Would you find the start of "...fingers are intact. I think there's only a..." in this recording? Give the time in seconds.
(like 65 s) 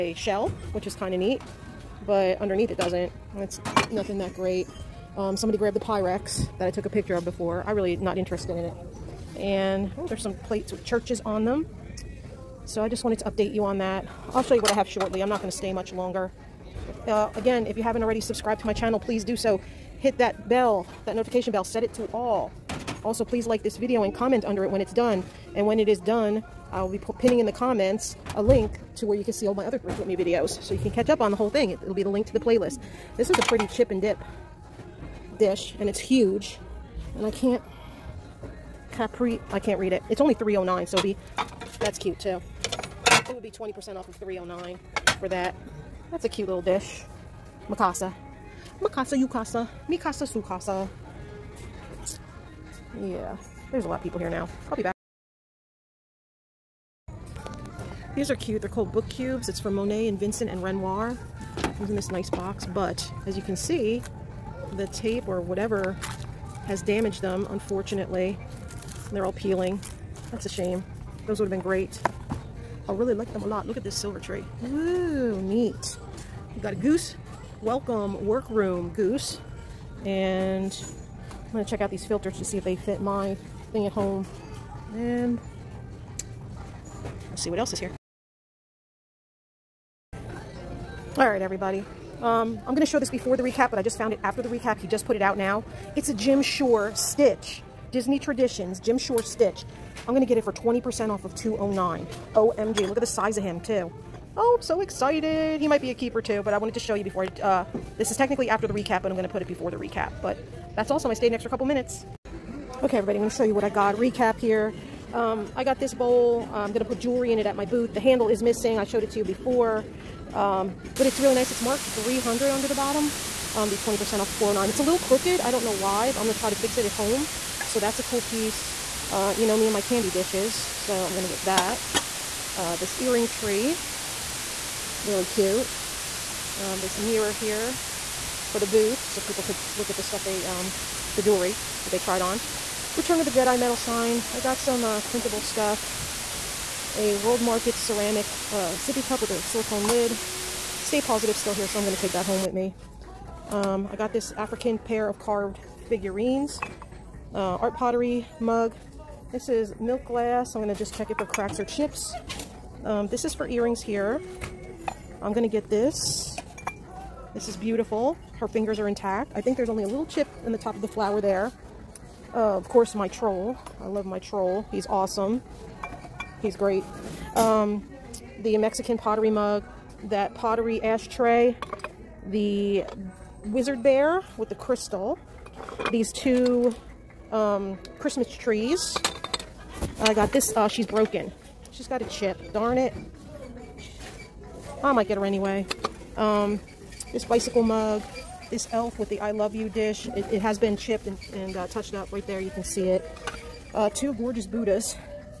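168 s.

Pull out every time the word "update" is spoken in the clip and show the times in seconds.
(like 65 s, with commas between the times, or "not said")
13 s.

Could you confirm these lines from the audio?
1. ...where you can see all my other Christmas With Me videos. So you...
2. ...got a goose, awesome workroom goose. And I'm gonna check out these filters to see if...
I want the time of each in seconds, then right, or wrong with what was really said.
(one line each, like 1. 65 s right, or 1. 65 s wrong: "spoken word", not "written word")
1. 29 s wrong: "Thrift", not "Christmas"
2. 76 s wrong: "welcome", not "awesome".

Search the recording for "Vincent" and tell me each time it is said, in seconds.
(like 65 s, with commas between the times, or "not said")
60 s.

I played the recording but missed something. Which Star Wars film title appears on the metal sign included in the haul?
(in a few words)
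Return of the Jedi.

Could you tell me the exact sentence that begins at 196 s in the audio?
Um, this bicycle mug, this elf with the I love you dish.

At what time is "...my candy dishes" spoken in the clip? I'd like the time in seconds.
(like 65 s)
129 s.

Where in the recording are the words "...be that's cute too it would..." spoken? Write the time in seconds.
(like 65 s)
41 s.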